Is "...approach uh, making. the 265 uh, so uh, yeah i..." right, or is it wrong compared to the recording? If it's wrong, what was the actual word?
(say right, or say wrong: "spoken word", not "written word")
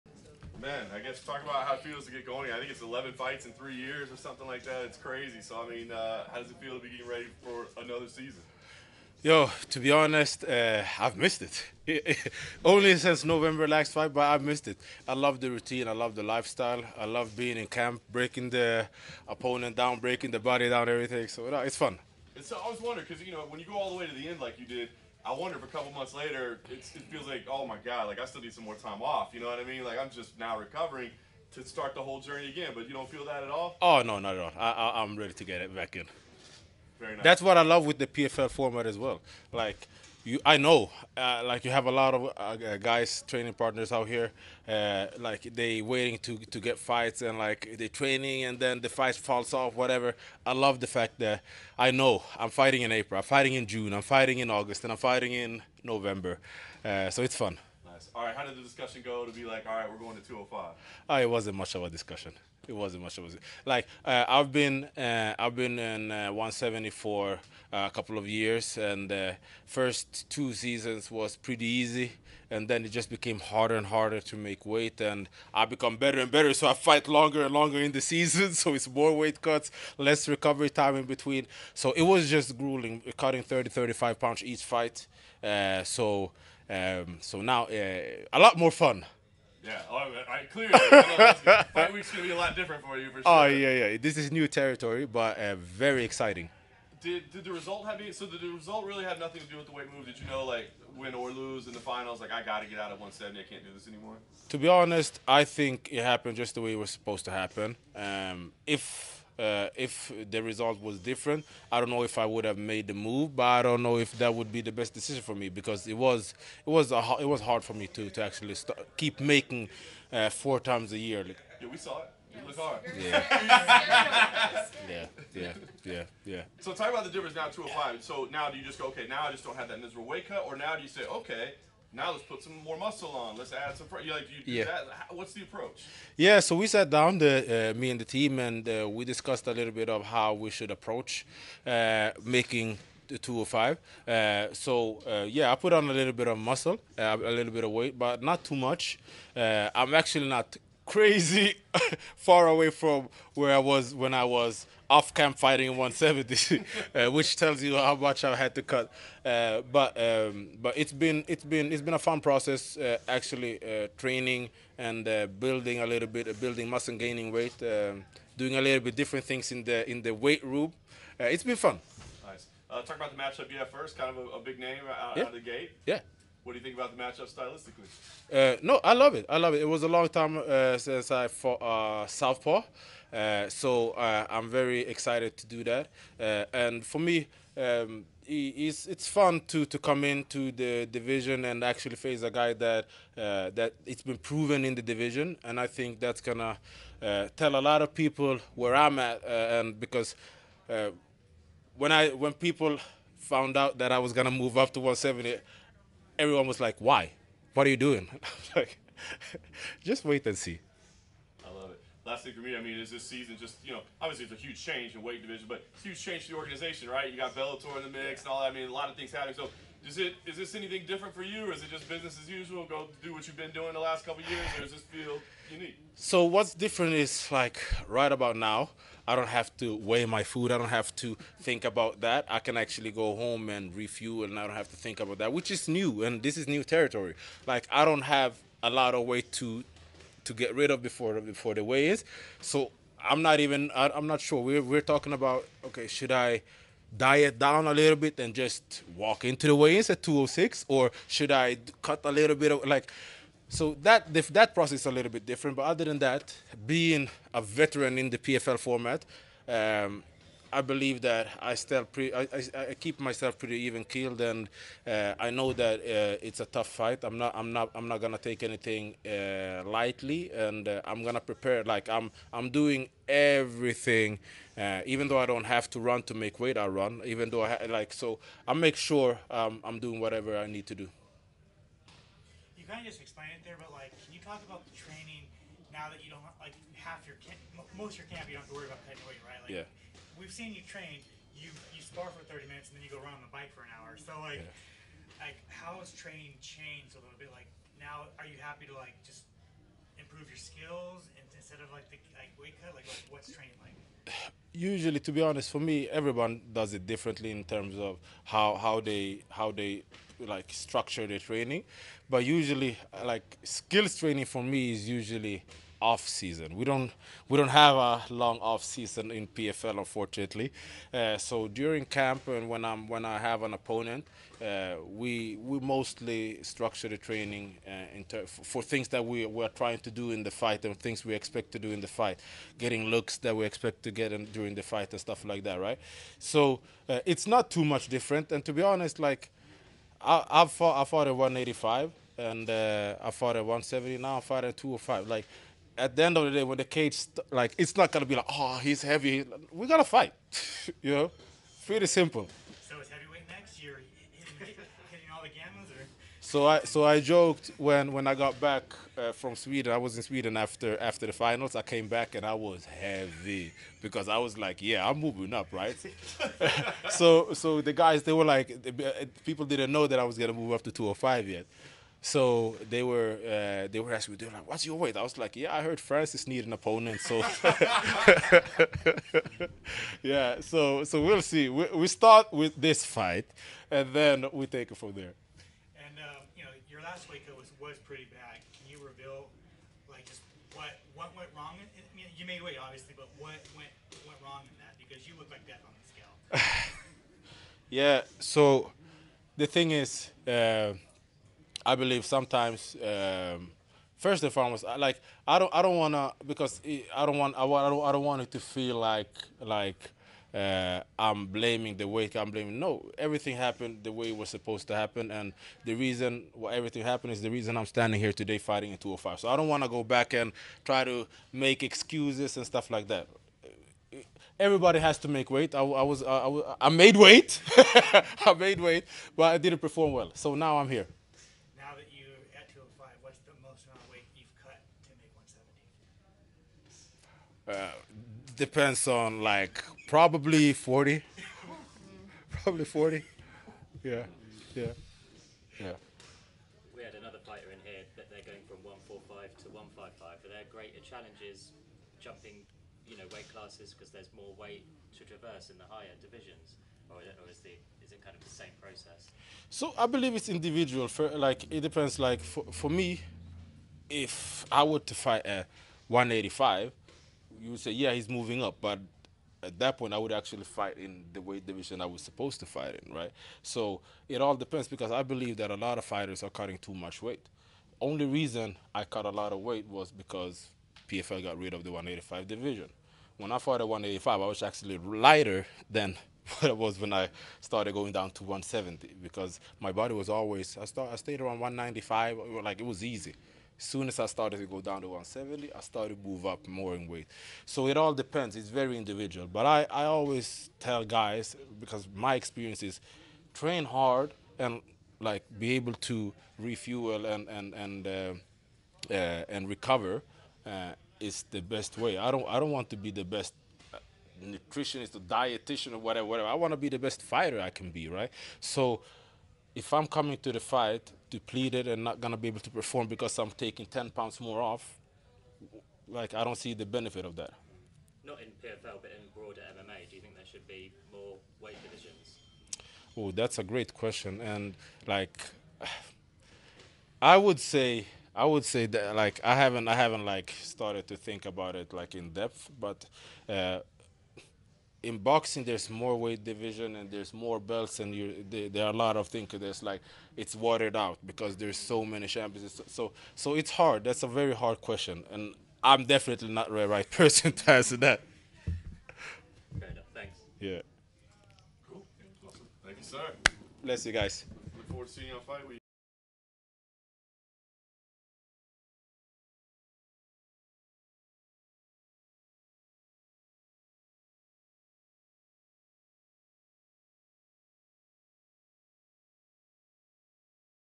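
wrong: "205", not "265".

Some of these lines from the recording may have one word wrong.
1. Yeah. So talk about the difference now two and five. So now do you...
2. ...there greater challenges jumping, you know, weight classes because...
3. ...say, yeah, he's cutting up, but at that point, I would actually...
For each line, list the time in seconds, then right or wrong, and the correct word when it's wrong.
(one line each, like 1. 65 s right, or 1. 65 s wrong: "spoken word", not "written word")
1. 126 s right
2. 450 s right
3. 467 s wrong: "moving", not "cutting".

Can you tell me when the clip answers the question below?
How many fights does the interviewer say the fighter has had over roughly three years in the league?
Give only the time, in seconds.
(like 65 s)
2 s.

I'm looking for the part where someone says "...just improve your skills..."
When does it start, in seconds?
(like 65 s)
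299 s.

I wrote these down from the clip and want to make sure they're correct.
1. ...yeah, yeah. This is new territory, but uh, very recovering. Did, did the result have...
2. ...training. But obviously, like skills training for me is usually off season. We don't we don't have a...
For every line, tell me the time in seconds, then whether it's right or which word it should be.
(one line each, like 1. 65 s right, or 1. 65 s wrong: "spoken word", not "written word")
1. 93 s wrong: "exciting", not "recovering"
2. 311 s wrong: "usually", not "obviously".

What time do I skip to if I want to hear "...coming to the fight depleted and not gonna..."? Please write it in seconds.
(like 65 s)
519 s.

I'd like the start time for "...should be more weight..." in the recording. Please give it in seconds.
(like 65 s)
530 s.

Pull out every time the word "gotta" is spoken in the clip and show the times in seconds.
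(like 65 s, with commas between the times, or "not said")
102 s, 349 s.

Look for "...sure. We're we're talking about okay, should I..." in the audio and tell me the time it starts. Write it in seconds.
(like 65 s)
244 s.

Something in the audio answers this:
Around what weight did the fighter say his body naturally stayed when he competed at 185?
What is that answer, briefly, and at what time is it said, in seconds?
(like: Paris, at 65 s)
195, at 491 s.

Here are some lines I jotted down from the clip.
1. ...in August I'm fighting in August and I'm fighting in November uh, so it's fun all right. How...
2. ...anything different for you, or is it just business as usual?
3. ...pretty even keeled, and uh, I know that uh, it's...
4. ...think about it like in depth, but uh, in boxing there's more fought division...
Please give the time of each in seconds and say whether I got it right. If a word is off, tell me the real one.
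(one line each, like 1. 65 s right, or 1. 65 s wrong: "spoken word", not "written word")
1. 53 s wrong: "June", not "August"
2. 220 s right
3. 263 s right
4. 540 s wrong: "weight", not "fought".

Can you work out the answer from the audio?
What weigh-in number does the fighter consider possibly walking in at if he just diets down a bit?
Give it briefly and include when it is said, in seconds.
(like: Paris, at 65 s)
206, at 250 s.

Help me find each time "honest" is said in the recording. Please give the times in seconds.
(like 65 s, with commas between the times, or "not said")
9 s, 104 s, 305 s, 338 s.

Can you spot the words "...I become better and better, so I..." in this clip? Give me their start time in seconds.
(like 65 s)
75 s.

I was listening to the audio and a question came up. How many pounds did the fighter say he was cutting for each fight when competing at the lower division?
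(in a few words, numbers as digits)
30 to 35.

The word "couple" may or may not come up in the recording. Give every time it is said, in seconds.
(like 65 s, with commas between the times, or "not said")
25 s, 67 s, 224 s.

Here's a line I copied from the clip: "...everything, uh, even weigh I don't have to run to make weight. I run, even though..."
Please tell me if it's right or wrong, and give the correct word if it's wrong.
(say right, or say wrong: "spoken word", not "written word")
wrong: "though", not "weigh".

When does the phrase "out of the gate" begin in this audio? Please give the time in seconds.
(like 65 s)
175 s.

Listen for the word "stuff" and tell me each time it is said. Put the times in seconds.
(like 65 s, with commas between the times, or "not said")
335 s, 422 s.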